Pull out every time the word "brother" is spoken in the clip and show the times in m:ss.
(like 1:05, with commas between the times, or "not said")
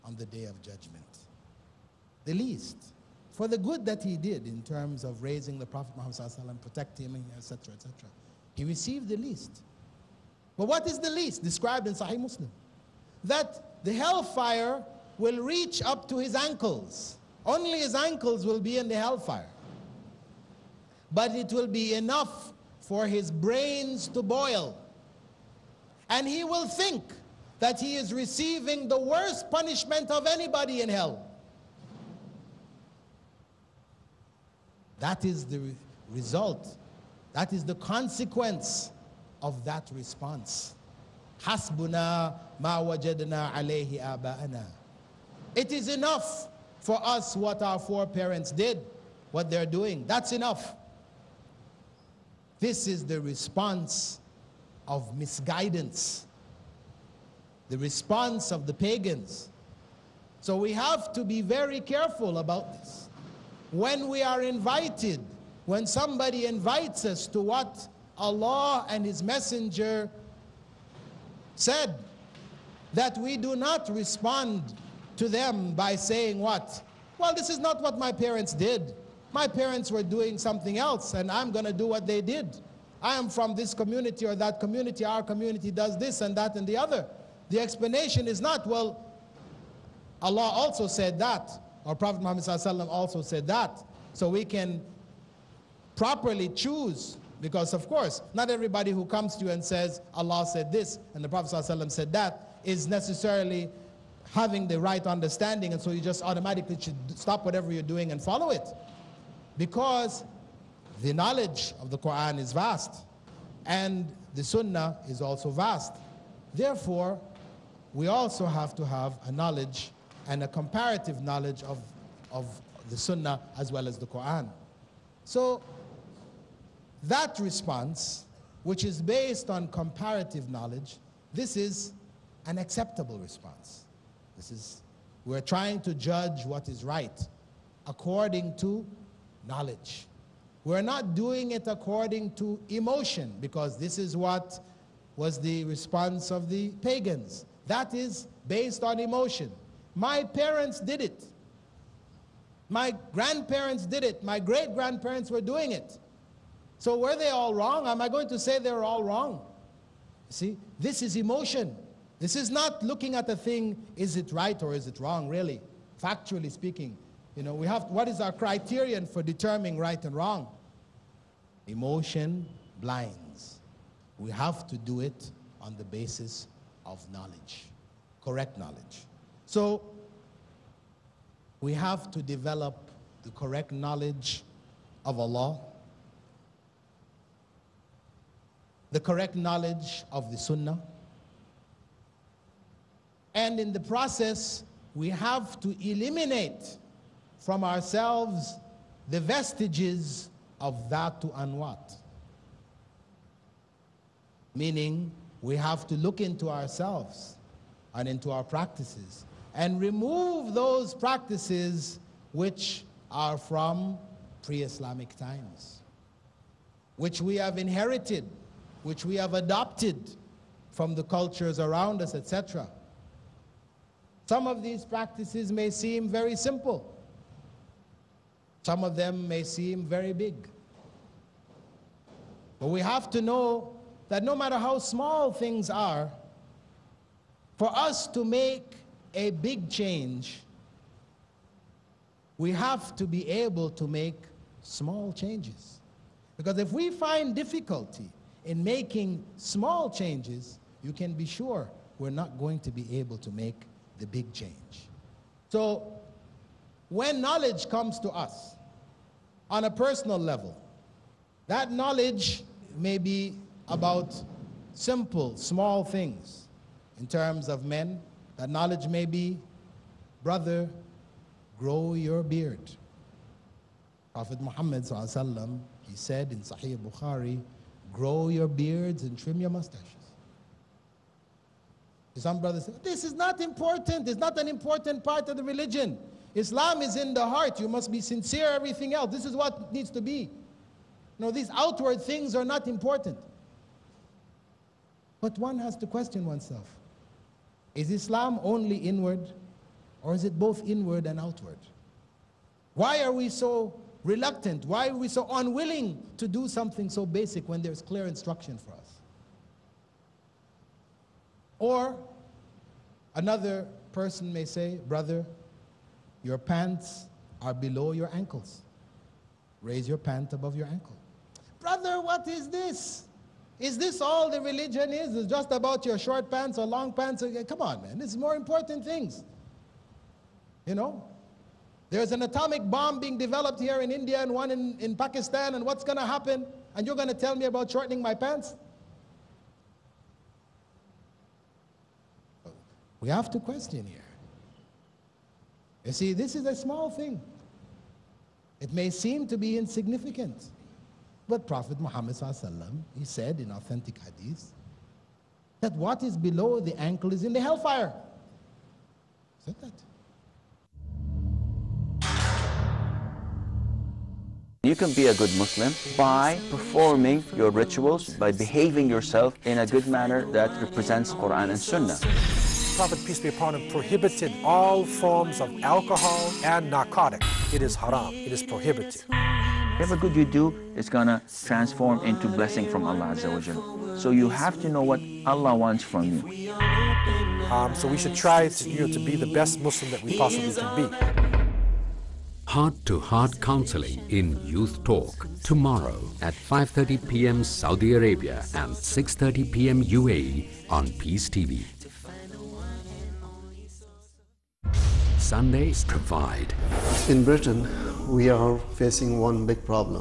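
4:30, 4:42, 5:14, 5:21.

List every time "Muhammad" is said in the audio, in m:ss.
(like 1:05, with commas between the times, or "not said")
0:05, 1:32, 4:34, 5:51.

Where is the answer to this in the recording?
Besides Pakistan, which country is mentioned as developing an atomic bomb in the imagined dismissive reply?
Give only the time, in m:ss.
5:33.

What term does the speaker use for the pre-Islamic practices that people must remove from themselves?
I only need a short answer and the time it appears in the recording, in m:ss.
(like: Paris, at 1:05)
Dhatu Anwat, at 3:20.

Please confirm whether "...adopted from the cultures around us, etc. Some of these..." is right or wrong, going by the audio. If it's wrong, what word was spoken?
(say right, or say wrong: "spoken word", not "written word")
right.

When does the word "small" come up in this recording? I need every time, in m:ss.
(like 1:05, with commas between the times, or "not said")
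3:54, 4:04, 4:09, 4:25, 5:46.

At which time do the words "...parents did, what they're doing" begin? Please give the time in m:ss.
0:48.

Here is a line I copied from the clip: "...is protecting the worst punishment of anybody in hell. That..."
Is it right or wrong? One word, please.
wrong.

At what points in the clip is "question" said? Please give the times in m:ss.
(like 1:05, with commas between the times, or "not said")
4:55, 5:43.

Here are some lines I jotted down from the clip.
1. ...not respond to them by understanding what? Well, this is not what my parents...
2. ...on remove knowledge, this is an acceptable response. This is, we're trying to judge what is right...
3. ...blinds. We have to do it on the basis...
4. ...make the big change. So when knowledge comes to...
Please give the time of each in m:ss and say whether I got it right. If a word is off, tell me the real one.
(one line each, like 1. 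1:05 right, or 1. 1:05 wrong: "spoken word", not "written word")
1. 1:13 wrong: "saying", not "understanding"
2. 2:09 wrong: "comparative", not "remove"
3. 2:52 right
4. 4:13 right.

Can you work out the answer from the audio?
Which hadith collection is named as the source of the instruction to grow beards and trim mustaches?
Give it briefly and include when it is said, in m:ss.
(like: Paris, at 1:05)
Sahih Bukhari, at 4:36.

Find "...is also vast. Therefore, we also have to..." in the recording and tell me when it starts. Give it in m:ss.
1:55.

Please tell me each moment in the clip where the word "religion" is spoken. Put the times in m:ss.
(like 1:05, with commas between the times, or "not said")
4:45, 5:24.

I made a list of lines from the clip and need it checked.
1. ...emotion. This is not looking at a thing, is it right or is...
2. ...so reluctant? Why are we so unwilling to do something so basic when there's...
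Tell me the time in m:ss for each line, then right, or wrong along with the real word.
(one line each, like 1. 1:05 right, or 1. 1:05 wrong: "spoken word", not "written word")
1. 2:41 right
2. 5:03 right.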